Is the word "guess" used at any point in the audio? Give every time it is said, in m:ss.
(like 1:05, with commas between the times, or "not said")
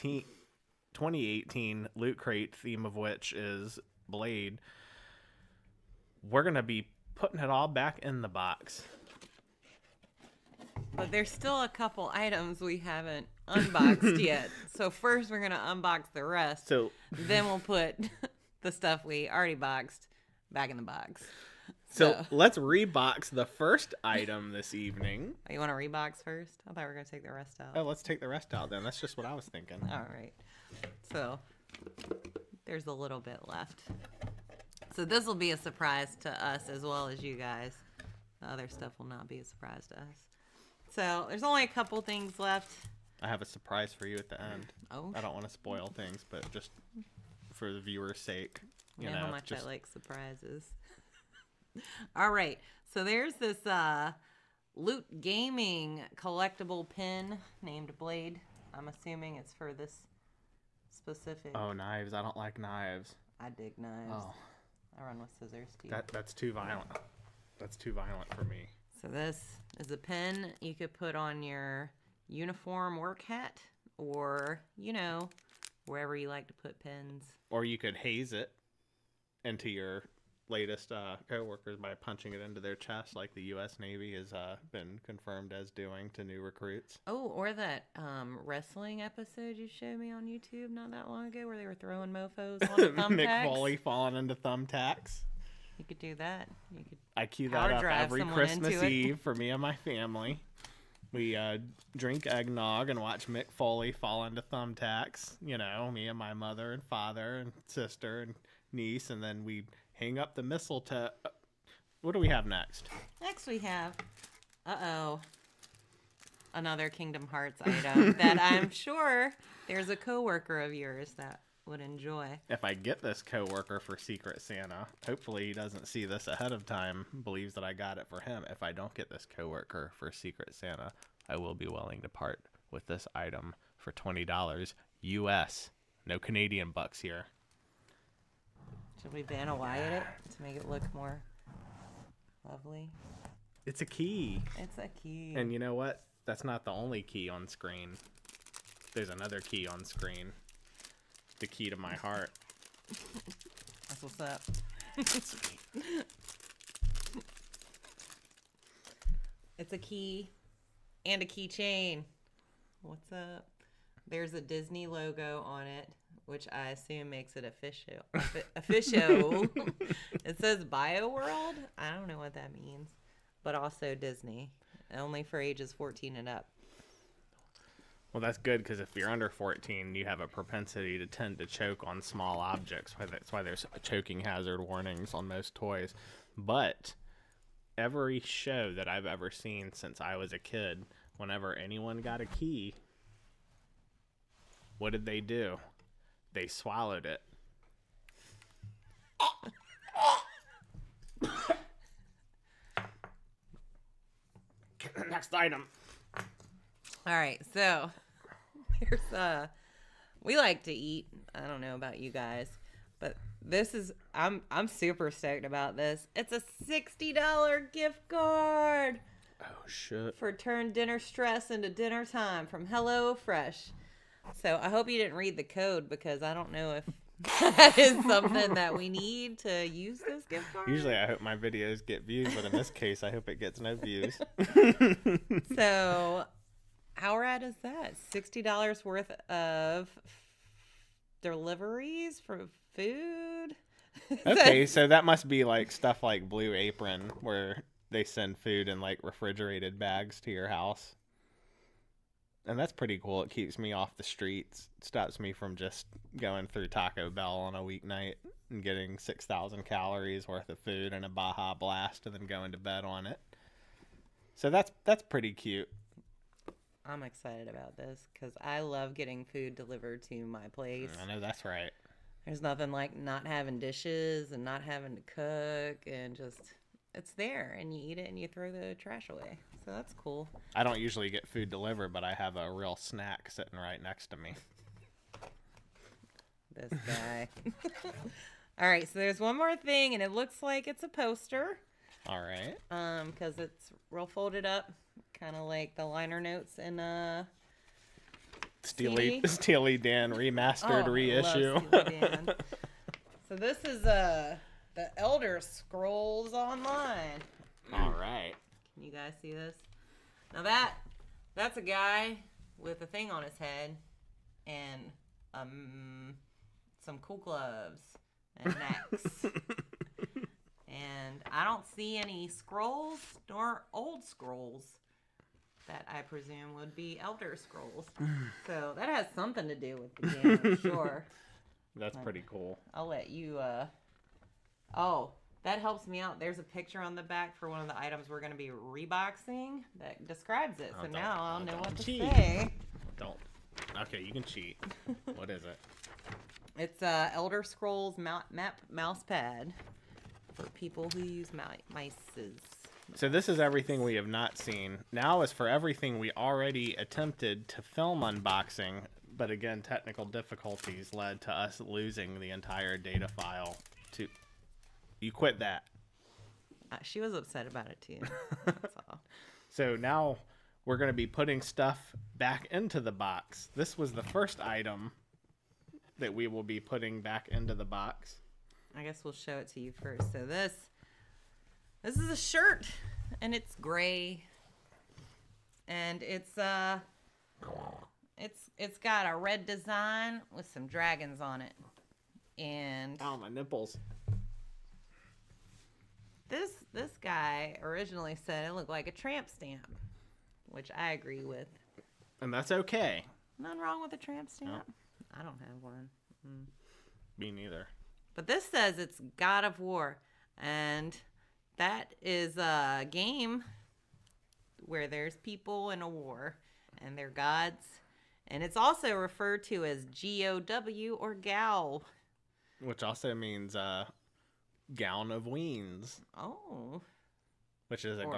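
6:18.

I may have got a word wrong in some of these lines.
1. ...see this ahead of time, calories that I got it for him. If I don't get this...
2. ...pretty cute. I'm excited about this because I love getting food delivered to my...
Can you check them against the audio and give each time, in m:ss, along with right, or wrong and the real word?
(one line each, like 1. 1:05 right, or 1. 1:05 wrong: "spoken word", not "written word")
1. 2:05 wrong: "believes", not "calories"
2. 4:25 right.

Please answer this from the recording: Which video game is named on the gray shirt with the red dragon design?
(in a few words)
God of War.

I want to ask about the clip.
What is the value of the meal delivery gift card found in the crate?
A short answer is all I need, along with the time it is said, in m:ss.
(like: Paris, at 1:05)
$60, at 3:36.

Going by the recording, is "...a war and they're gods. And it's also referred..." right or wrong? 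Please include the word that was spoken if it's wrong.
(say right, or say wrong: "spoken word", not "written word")
right.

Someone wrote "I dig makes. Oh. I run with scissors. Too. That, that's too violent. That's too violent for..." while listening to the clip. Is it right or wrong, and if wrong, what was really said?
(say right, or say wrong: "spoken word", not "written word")
wrong: "knives", not "makes".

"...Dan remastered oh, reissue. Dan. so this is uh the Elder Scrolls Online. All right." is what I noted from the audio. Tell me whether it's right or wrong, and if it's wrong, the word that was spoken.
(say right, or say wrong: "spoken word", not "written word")
right.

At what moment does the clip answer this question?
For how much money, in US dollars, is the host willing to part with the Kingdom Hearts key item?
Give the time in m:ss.
2:13.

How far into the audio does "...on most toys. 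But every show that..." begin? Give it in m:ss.
3:05.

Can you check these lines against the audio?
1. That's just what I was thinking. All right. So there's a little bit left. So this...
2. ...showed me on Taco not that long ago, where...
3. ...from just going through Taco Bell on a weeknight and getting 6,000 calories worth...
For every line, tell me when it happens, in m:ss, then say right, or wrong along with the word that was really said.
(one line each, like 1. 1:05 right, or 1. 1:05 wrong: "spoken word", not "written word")
1. 0:28 right
2. 1:29 wrong: "YouTube", not "Taco"
3. 4:15 right.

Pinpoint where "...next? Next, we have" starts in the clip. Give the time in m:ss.
1:52.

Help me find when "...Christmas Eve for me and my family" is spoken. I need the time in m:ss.
1:38.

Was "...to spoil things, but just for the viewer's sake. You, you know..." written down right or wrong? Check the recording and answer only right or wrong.
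right.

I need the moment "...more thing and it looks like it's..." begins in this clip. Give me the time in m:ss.
4:49.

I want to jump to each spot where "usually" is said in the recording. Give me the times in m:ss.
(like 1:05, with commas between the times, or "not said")
3:50, 4:40.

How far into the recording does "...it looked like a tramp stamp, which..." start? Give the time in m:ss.
6:38.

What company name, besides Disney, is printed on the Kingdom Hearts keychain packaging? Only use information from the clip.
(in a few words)
Bioworld.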